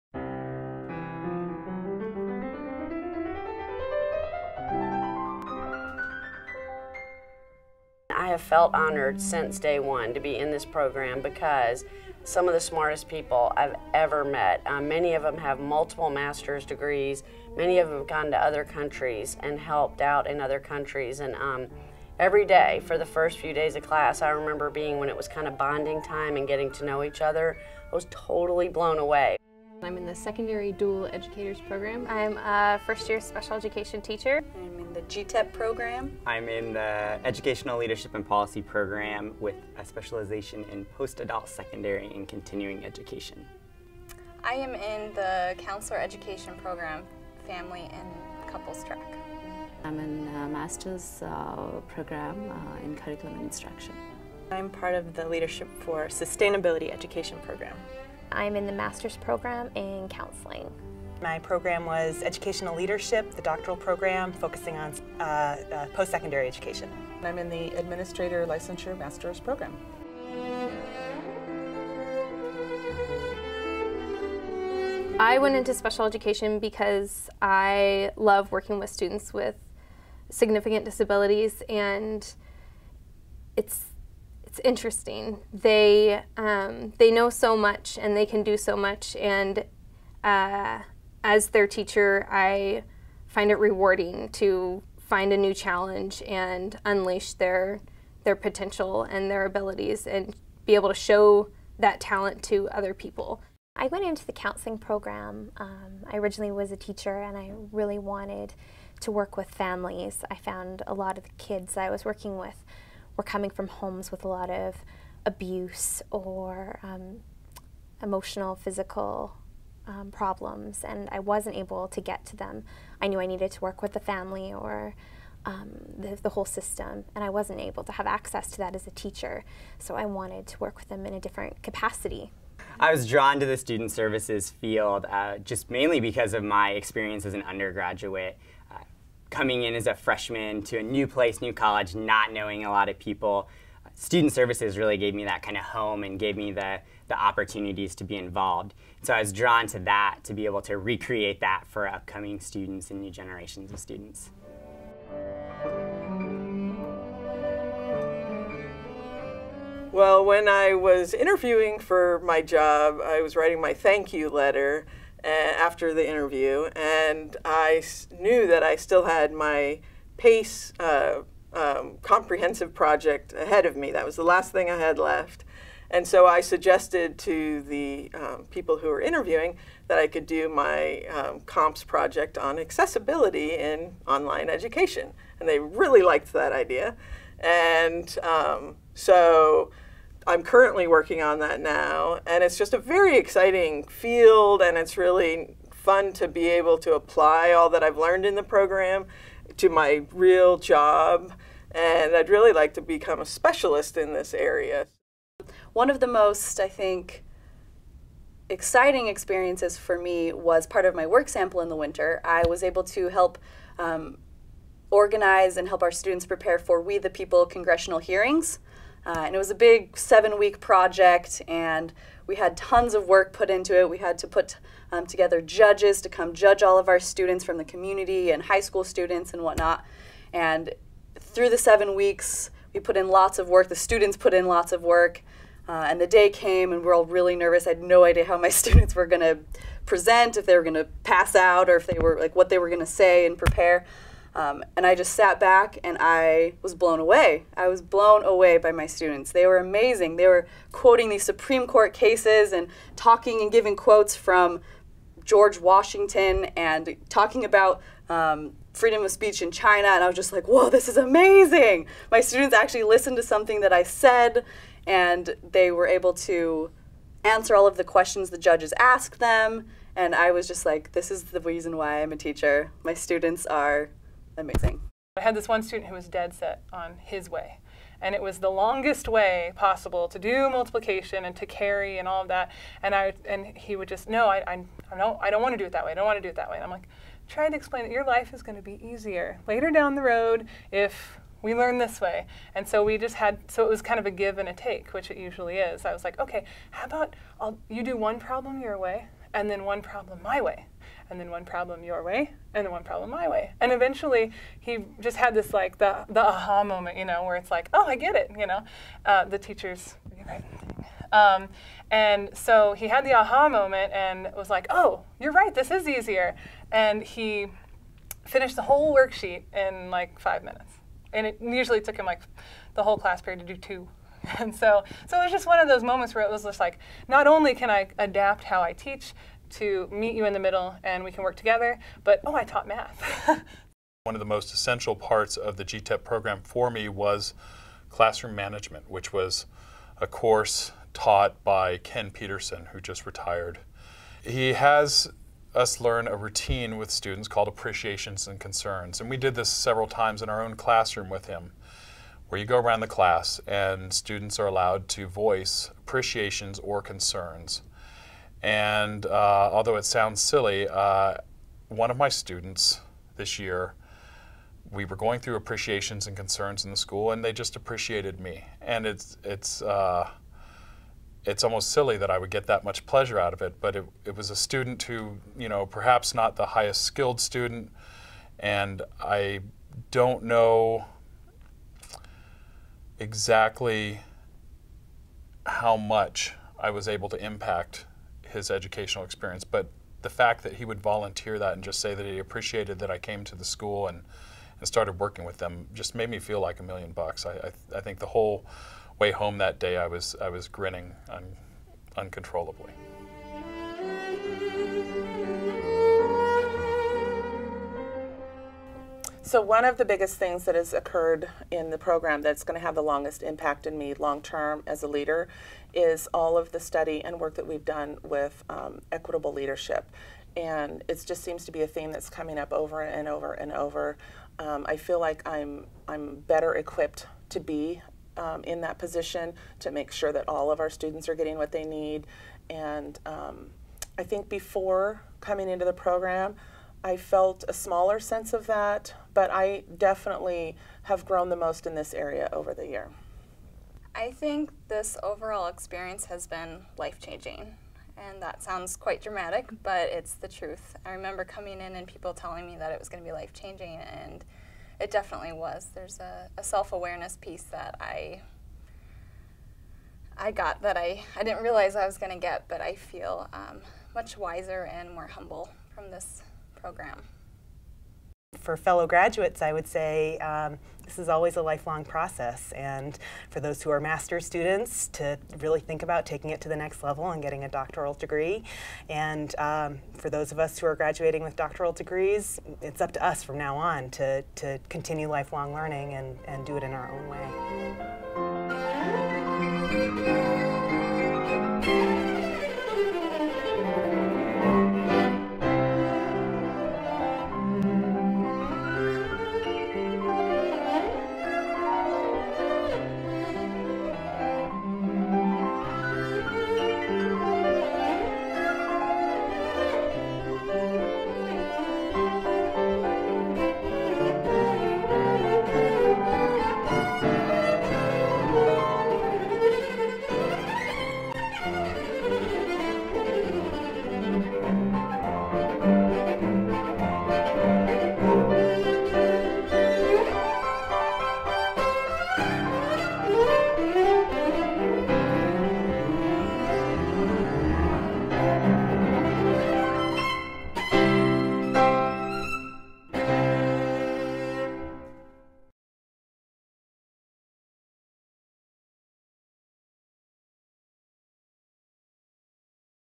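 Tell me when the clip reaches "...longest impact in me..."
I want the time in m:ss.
6:52.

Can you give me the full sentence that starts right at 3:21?
And I'd really like to become a specialist in this area.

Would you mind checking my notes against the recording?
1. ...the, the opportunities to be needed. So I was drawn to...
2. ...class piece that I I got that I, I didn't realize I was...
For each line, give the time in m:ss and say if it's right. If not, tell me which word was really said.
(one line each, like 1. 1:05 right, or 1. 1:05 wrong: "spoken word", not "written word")
1. 2:26 wrong: "involved", not "needed"
2. 7:36 wrong: "awareness", not "class".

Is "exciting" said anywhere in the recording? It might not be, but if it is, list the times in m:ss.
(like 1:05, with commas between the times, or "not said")
3:13, 3:28.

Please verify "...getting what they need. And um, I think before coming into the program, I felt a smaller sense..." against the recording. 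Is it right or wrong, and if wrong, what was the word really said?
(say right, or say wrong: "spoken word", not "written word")
right.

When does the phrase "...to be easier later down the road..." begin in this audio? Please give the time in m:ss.
4:48.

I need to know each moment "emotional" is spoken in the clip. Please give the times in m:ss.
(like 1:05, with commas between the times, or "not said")
1:58.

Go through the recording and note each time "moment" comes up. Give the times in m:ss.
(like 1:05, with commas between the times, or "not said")
5:06, 5:13, 5:25.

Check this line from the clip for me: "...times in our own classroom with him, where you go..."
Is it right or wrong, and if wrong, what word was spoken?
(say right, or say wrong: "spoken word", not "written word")
right.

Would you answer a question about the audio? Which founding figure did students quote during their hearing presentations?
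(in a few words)
George Washington.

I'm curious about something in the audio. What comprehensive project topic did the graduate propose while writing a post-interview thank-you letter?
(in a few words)
Accessibility in online education.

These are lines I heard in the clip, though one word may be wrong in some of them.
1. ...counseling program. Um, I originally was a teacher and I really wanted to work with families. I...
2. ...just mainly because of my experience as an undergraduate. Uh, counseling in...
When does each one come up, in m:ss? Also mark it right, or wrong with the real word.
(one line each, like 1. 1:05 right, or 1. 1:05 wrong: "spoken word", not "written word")
1. 1:44 right
2. 2:15 wrong: "coming", not "counseling".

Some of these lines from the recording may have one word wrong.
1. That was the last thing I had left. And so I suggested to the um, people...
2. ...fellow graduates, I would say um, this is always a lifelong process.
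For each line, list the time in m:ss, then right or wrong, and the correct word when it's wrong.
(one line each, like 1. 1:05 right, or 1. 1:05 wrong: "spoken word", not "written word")
1. 2:53 right
2. 7:48 right.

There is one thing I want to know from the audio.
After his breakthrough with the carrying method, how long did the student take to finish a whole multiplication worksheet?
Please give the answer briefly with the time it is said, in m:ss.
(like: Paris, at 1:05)
5 minutes, at 5:20.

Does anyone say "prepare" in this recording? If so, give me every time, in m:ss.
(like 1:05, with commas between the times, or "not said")
3:36, 4:03.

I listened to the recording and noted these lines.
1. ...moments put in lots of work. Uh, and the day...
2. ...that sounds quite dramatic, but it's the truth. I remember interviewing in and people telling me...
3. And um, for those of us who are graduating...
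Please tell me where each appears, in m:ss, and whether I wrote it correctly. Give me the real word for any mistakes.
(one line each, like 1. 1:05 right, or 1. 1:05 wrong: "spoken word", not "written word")
1. 3:53 wrong: "students", not "moments"
2. 7:28 wrong: "coming", not "interviewing"
3. 7:58 right.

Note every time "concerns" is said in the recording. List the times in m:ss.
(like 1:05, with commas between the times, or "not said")
5:48, 5:56, 6:06.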